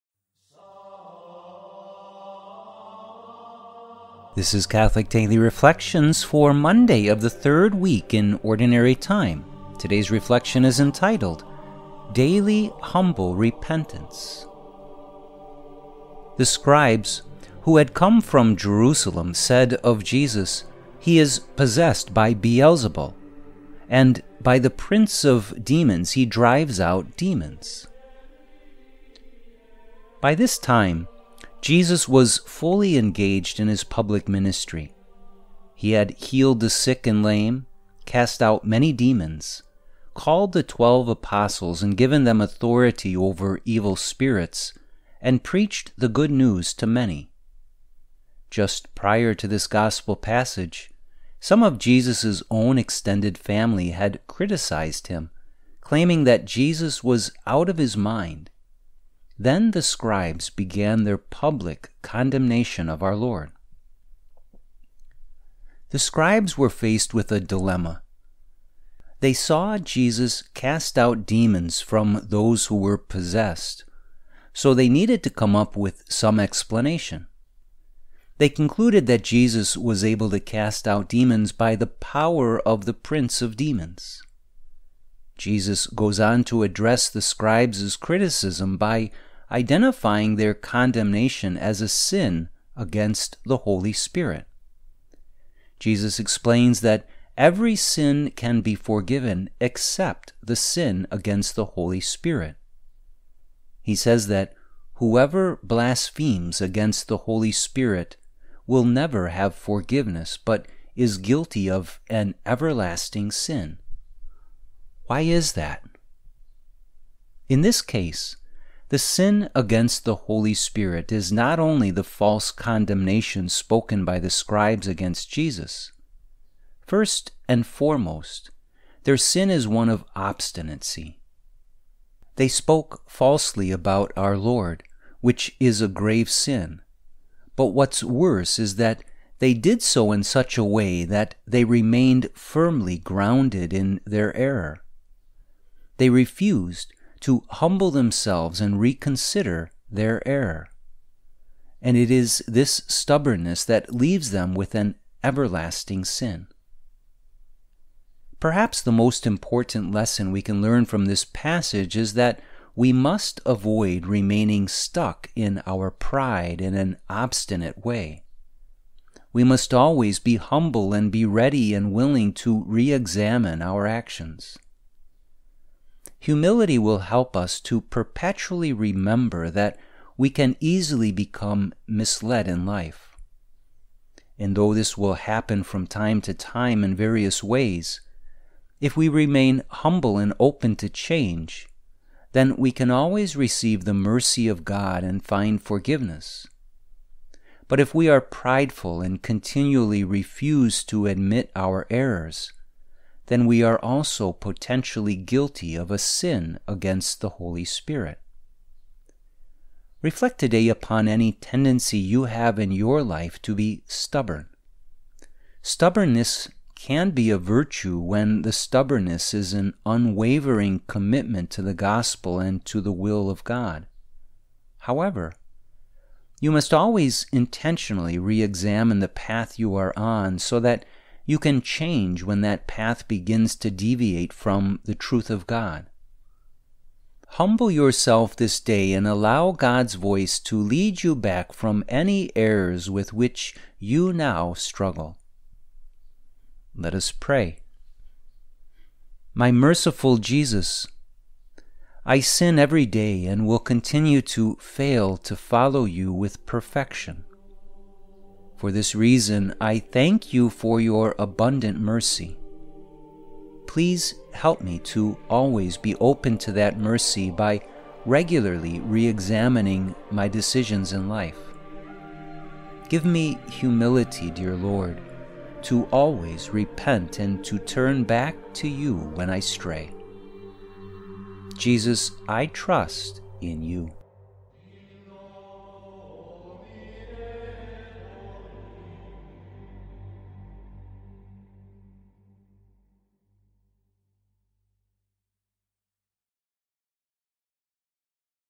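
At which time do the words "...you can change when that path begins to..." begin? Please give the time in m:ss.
3:51.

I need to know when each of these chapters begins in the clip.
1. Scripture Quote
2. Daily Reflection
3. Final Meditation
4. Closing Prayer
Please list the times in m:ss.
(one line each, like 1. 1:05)
1. 0:15
2. 0:29
3. 3:29
4. 4:09.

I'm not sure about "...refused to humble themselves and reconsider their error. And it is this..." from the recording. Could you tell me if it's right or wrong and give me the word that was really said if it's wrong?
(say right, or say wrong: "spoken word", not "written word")
right.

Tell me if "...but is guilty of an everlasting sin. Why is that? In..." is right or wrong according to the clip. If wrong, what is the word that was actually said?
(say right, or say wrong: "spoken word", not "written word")
right.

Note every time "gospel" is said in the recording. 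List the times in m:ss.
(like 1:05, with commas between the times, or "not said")
0:49, 3:41.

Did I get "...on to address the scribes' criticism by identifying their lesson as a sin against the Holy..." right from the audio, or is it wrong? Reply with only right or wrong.
wrong.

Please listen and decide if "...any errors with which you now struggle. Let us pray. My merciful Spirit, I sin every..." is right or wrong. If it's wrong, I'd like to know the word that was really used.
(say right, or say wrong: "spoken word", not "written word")
wrong: "Jesus", not "Spirit".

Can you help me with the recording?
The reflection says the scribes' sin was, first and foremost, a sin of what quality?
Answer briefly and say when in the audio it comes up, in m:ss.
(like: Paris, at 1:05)
Obstinacy, at 2:10.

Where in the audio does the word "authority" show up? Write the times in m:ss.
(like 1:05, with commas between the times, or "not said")
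0:42.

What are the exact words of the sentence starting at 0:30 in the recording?
By this time, Jesus was fully engaged in his public ministry.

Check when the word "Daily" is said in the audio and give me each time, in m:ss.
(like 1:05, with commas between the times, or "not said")
0:05, 0:12.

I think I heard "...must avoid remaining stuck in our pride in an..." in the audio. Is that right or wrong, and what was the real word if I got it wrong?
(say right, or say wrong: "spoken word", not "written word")
right.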